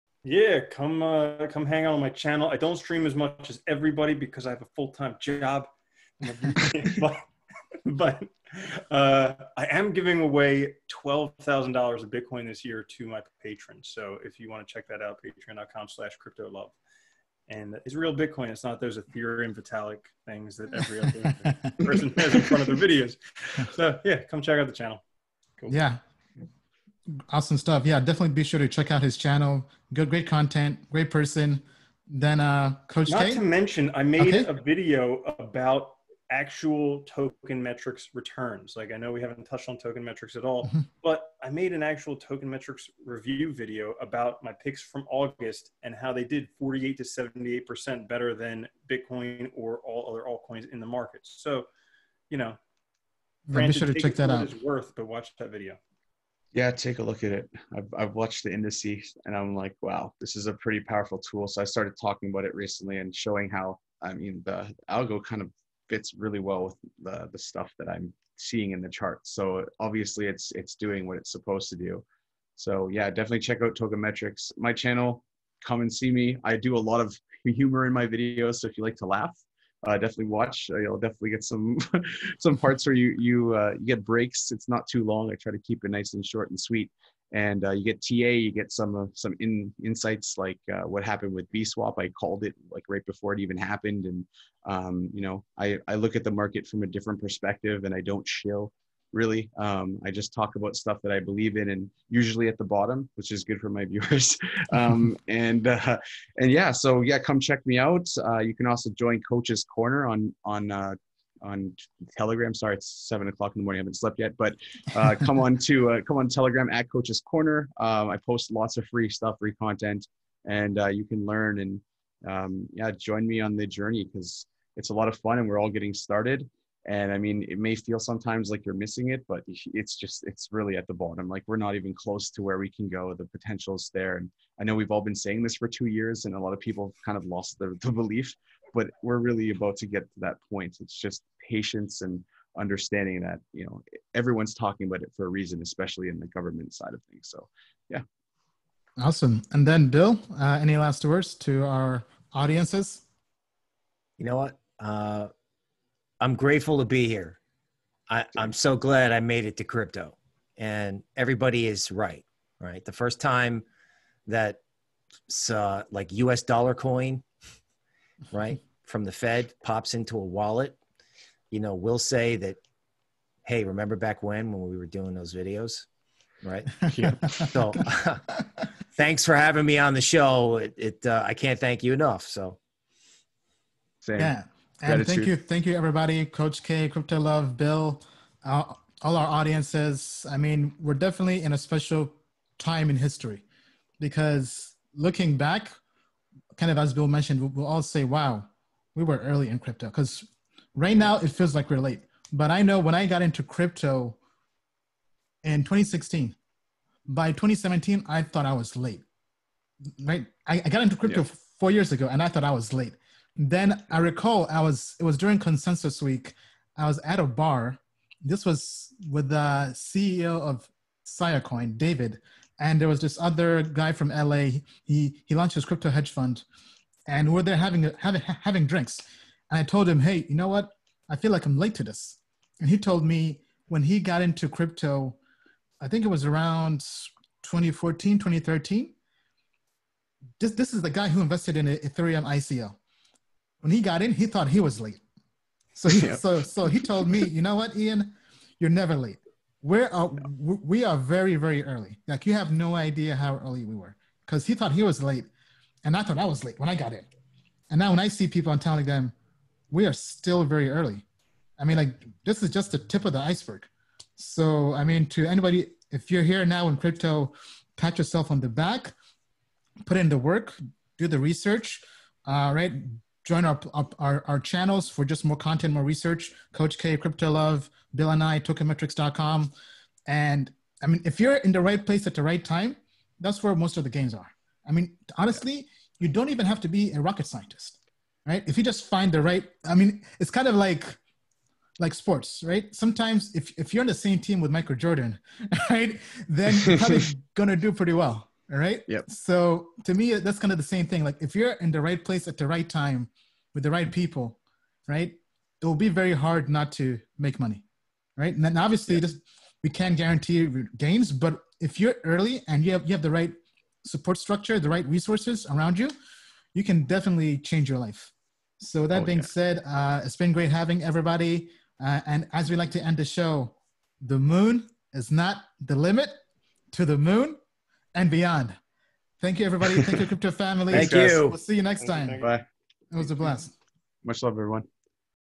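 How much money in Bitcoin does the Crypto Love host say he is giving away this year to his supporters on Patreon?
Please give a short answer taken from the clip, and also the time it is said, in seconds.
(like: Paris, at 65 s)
$12,000, at 10 s.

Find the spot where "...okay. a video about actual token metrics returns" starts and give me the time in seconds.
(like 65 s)
34 s.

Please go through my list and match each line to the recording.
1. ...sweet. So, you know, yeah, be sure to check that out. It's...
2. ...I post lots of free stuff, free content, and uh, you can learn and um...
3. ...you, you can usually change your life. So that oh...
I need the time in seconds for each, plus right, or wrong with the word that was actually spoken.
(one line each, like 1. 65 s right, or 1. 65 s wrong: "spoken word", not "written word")
1. 50 s wrong: "market", not "sweet"
2. 118 s right
3. 315 s wrong: "definitely", not "usually".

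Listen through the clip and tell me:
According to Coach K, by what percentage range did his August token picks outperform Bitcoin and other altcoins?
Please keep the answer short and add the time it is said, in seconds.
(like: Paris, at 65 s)
48 to 78%, at 46 s.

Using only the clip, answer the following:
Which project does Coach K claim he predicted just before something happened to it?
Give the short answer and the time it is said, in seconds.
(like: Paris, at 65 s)
BSwap, at 91 s.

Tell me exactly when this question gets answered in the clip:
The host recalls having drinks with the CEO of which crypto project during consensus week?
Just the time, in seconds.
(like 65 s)
221 s.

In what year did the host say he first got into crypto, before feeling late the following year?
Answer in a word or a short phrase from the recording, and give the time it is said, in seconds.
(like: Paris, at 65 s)
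2016, at 205 s.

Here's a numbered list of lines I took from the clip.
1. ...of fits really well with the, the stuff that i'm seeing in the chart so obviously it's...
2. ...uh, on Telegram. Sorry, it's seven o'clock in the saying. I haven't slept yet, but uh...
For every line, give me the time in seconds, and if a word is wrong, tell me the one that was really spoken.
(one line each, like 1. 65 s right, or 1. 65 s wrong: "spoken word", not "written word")
1. 65 s right
2. 110 s wrong: "morning", not "saying".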